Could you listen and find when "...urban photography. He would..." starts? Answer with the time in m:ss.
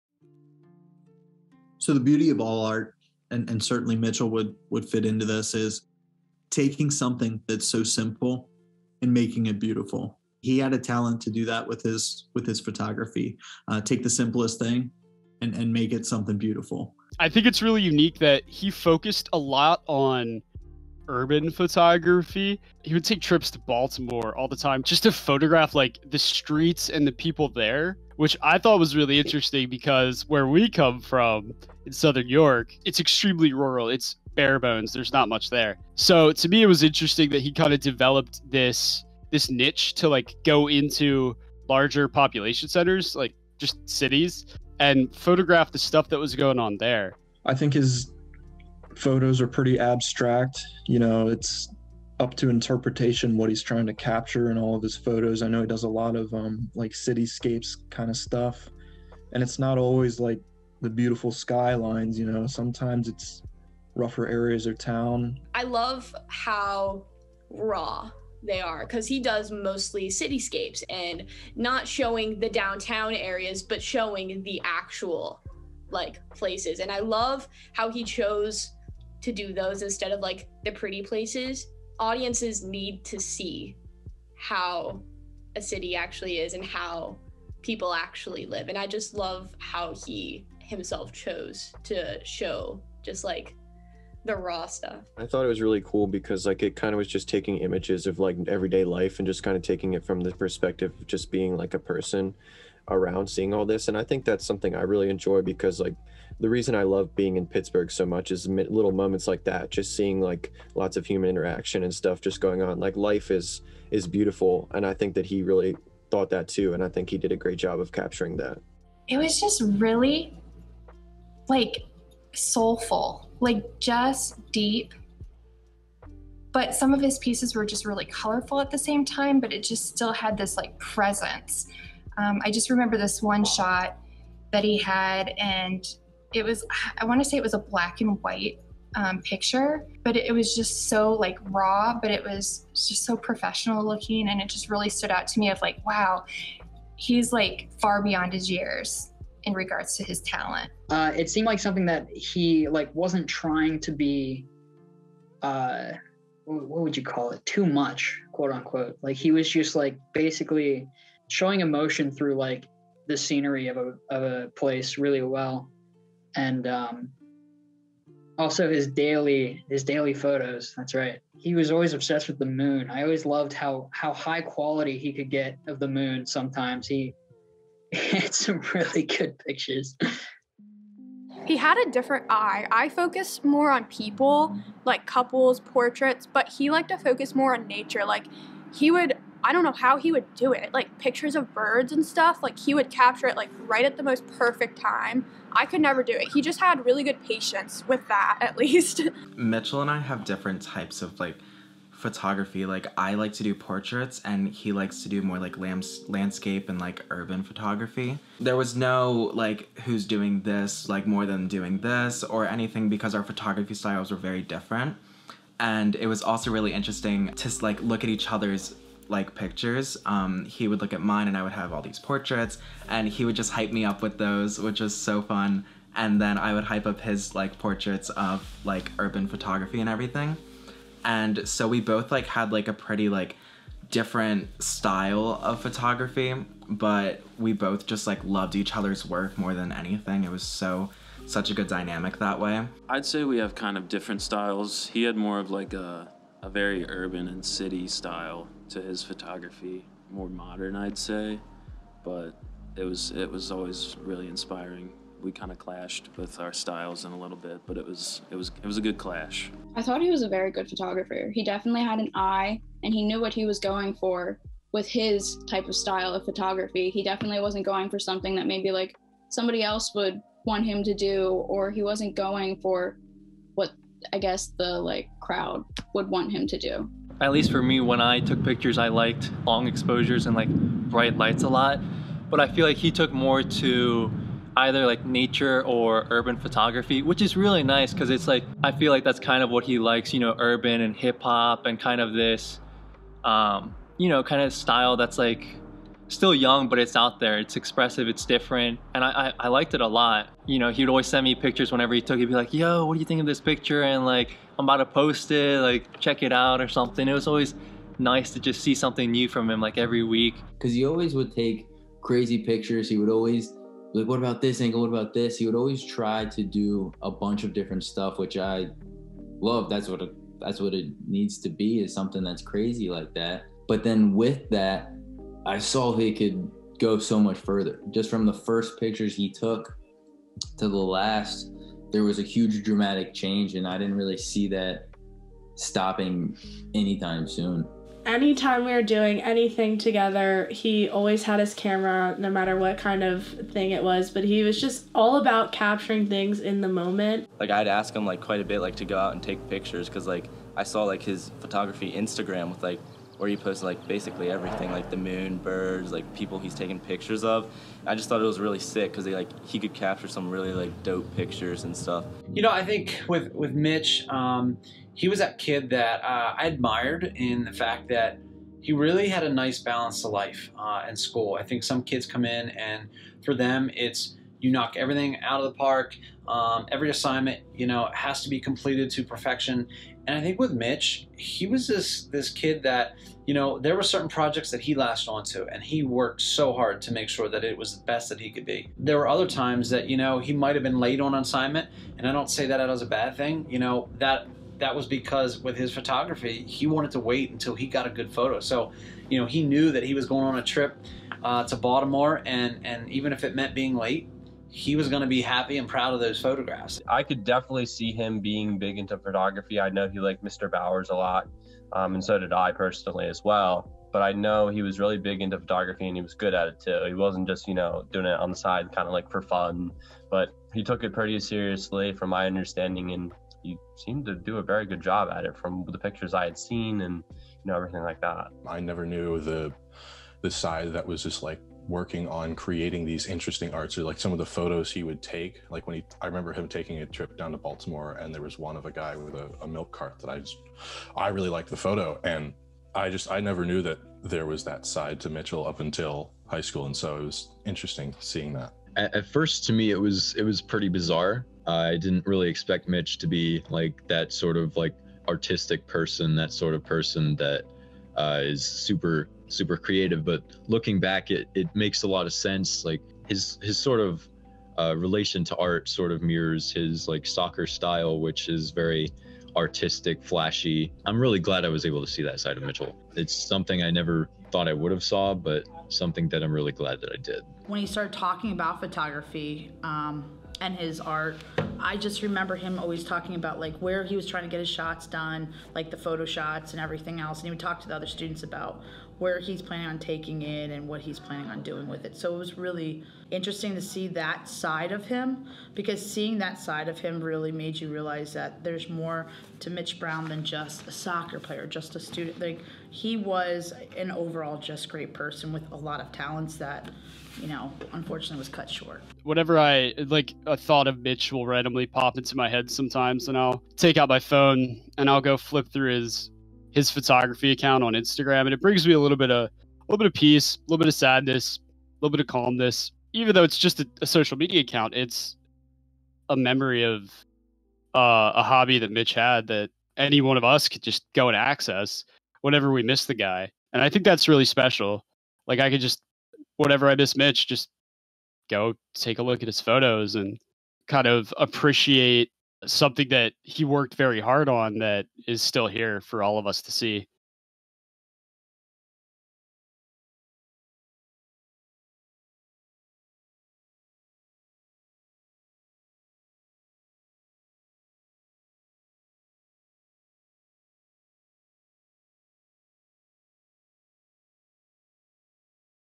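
0:21.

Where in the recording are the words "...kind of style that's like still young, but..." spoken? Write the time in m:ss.
4:54.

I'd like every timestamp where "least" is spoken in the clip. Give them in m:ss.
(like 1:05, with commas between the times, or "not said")
3:18, 4:37.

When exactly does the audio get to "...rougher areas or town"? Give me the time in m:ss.
1:03.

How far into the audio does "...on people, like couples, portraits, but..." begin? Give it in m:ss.
3:03.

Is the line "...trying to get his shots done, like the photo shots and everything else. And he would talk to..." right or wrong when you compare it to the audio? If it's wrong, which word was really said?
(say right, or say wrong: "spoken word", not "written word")
right.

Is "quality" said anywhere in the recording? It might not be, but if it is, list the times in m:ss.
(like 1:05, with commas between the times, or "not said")
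2:54.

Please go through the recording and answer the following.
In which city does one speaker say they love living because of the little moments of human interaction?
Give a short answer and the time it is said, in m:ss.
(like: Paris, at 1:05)
Pittsburgh, at 1:47.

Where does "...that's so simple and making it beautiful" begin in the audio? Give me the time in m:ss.
0:07.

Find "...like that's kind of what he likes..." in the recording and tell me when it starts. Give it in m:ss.
4:48.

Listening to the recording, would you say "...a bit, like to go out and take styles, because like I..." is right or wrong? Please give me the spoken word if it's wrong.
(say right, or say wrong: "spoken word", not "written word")
wrong: "pictures", not "styles".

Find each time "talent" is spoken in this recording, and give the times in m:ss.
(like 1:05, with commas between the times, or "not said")
0:10, 2:30, 8:25.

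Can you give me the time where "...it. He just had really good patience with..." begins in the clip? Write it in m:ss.
3:16.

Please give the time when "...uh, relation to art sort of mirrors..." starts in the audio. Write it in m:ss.
7:44.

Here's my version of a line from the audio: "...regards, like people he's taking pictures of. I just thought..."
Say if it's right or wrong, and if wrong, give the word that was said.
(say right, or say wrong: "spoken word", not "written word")
wrong: "birds", not "regards".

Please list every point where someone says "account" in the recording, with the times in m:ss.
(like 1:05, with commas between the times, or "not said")
8:37, 8:44.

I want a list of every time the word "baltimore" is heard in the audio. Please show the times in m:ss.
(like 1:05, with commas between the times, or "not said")
0:23, 6:41, 7:17.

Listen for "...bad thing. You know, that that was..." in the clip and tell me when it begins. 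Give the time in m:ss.
6:32.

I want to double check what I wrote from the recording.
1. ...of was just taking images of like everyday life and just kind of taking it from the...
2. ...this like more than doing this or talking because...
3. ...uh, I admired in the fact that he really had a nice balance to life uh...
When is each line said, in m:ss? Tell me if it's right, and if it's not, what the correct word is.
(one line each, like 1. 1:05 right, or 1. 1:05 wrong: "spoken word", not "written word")
1. 1:36 right
2. 3:30 wrong: "anything", not "talking"
3. 6:06 right.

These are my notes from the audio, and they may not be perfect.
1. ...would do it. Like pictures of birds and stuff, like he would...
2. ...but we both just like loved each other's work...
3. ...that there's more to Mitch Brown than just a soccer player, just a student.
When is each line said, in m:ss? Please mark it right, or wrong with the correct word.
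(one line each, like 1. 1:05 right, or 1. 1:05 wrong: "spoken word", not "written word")
1. 3:10 right
2. 3:56 right
3. 8:18 right.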